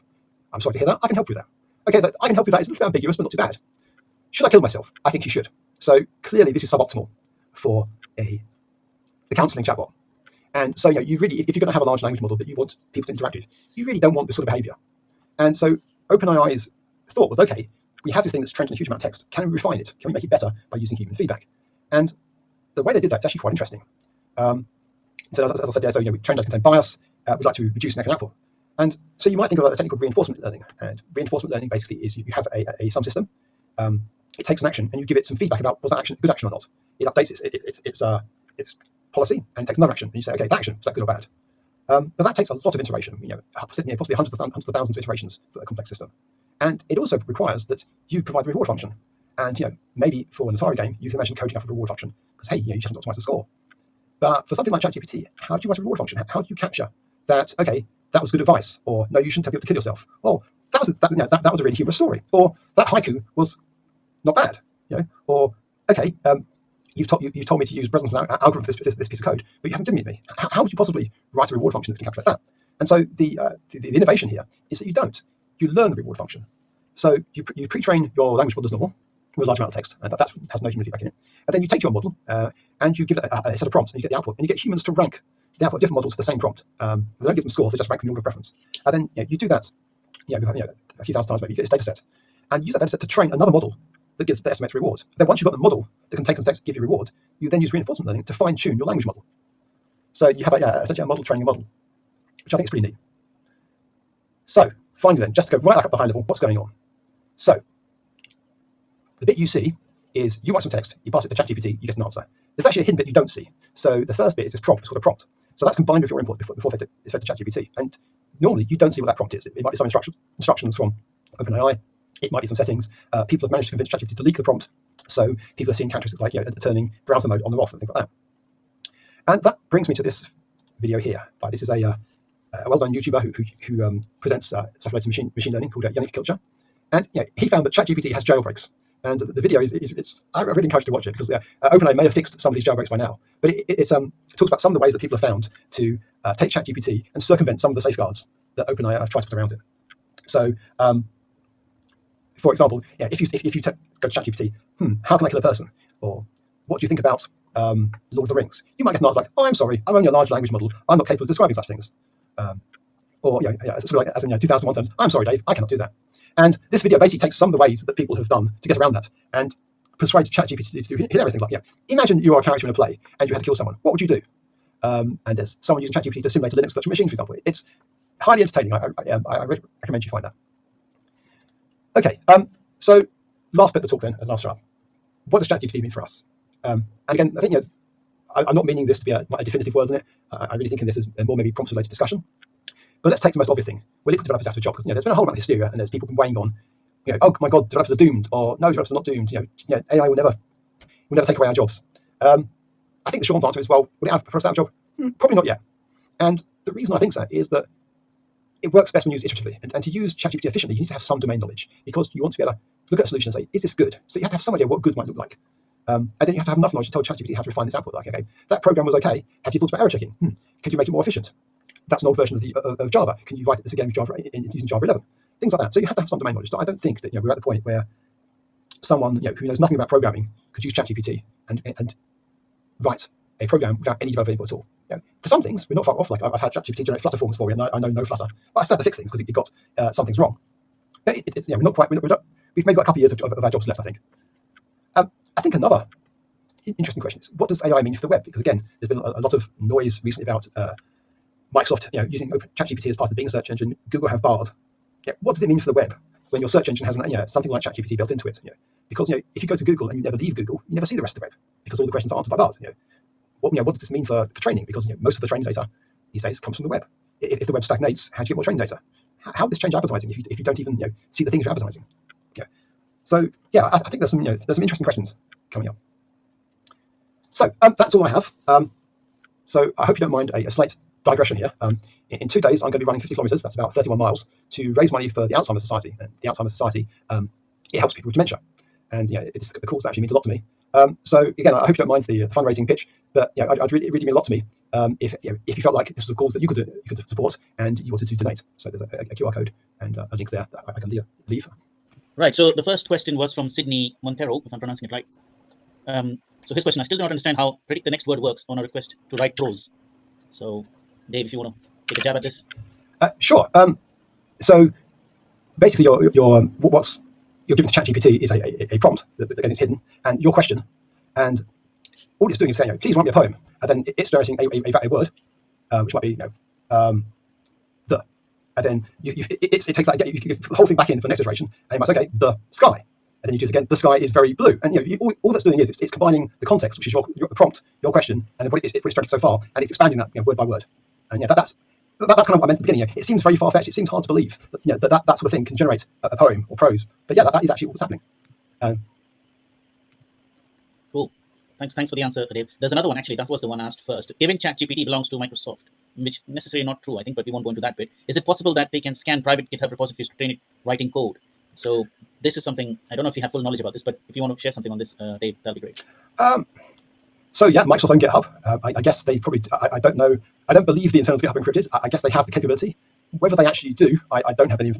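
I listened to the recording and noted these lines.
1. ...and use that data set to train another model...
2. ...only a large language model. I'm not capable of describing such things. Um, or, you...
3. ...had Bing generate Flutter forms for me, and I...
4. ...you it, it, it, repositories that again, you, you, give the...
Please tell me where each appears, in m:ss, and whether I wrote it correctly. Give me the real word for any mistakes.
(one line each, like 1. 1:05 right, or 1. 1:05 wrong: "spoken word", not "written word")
1. 1:32 right
2. 2:39 right
3. 3:56 wrong: "ChatGPT", not "Bing"
4. 5:29 wrong: "takes", not "repositories".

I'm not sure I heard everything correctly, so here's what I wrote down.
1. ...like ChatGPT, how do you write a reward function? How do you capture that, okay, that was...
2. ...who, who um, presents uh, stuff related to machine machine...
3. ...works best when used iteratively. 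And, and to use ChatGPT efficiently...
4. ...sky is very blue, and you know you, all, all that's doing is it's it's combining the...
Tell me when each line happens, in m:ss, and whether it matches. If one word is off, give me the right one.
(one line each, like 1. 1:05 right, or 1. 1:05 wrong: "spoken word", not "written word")
1. 0:54 right
2. 2:13 right
3. 3:28 right
4. 5:33 right.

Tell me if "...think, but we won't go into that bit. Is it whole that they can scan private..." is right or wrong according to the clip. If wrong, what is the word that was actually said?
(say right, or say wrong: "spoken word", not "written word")
wrong: "possible", not "whole".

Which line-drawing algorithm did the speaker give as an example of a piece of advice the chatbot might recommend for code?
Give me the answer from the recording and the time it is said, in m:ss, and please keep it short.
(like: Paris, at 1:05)
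Bresenham's algorithm, at 1:07.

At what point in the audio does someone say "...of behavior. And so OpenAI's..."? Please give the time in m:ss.
0:14.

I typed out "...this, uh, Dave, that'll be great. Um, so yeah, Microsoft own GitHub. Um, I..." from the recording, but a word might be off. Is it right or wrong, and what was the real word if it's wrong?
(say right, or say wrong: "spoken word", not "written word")
right.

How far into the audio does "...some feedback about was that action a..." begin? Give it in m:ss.
0:35.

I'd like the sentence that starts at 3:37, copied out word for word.
Like, okay, that program was okay.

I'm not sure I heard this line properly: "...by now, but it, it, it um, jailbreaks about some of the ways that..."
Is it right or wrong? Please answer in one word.
wrong.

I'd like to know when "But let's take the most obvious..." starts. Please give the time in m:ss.
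3:13.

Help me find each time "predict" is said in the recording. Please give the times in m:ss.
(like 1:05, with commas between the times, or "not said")
5:07.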